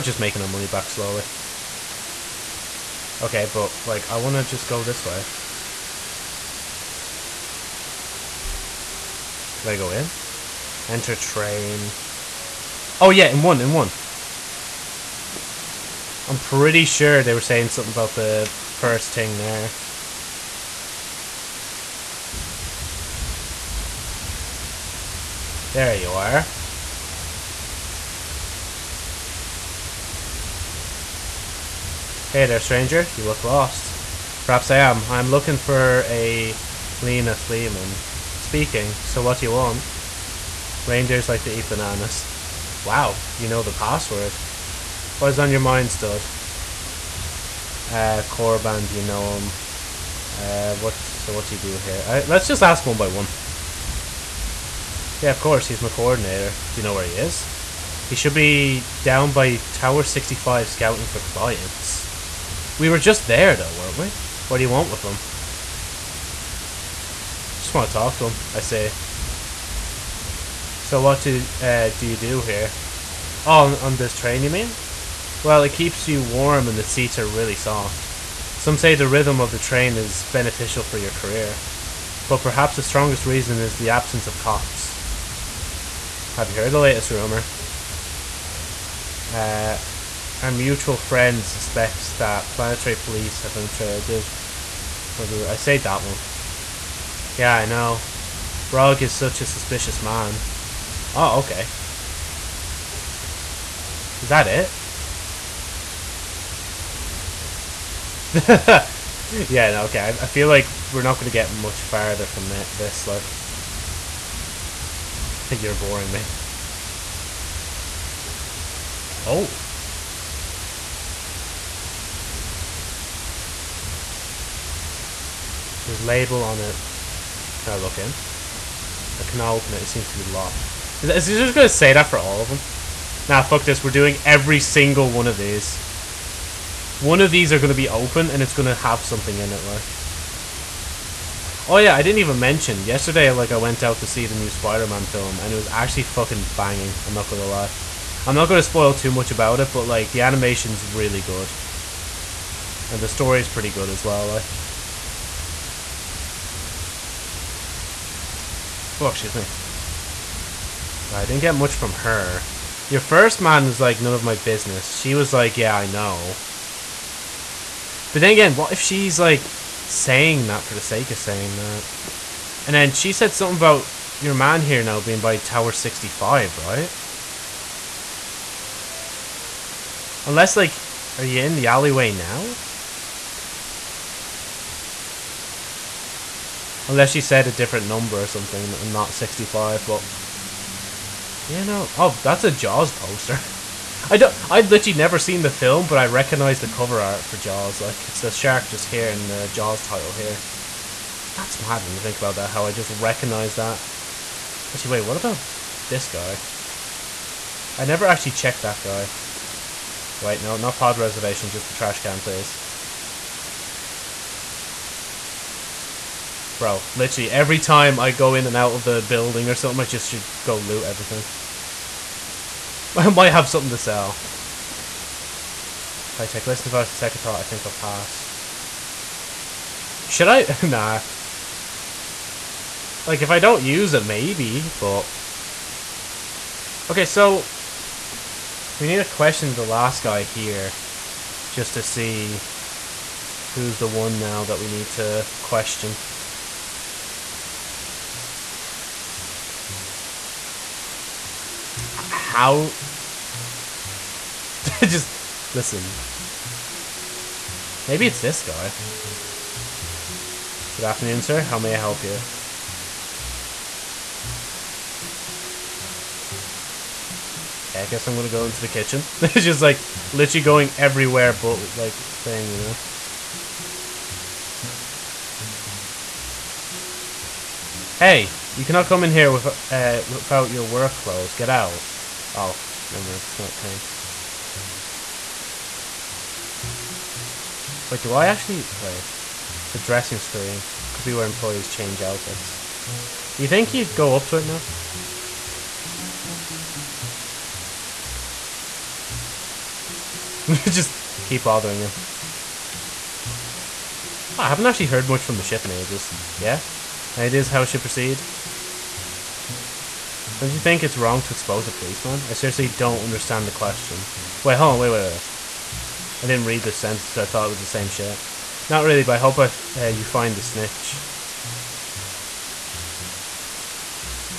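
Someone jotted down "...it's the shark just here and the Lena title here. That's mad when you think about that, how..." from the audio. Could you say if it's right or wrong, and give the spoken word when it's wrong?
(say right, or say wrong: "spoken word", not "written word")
wrong: "Jaws", not "Lena".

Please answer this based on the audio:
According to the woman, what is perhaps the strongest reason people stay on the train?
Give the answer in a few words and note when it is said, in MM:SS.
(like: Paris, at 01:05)
The absence of cops, at 01:23.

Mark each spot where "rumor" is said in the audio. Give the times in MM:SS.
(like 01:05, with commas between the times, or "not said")
01:27.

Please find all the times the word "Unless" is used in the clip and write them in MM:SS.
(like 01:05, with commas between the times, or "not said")
03:00, 03:06.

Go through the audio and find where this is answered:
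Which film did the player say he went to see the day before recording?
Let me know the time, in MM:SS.
02:24.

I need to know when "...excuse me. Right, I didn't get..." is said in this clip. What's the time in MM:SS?
02:39.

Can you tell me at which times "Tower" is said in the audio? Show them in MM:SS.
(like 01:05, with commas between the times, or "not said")
00:59, 02:55.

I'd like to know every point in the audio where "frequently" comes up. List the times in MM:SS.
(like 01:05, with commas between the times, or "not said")
not said.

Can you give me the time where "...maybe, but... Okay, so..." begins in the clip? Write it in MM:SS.
03:54.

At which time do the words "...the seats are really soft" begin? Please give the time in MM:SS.
01:16.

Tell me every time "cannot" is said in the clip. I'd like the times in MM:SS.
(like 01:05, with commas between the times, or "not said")
02:09, 04:38.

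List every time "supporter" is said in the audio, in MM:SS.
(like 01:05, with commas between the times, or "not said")
not said.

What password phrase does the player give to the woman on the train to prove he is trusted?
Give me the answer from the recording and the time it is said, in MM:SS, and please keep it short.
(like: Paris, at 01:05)
Reindeers like to eat bananas, at 00:40.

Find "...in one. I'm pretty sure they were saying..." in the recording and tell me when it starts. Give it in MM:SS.
00:13.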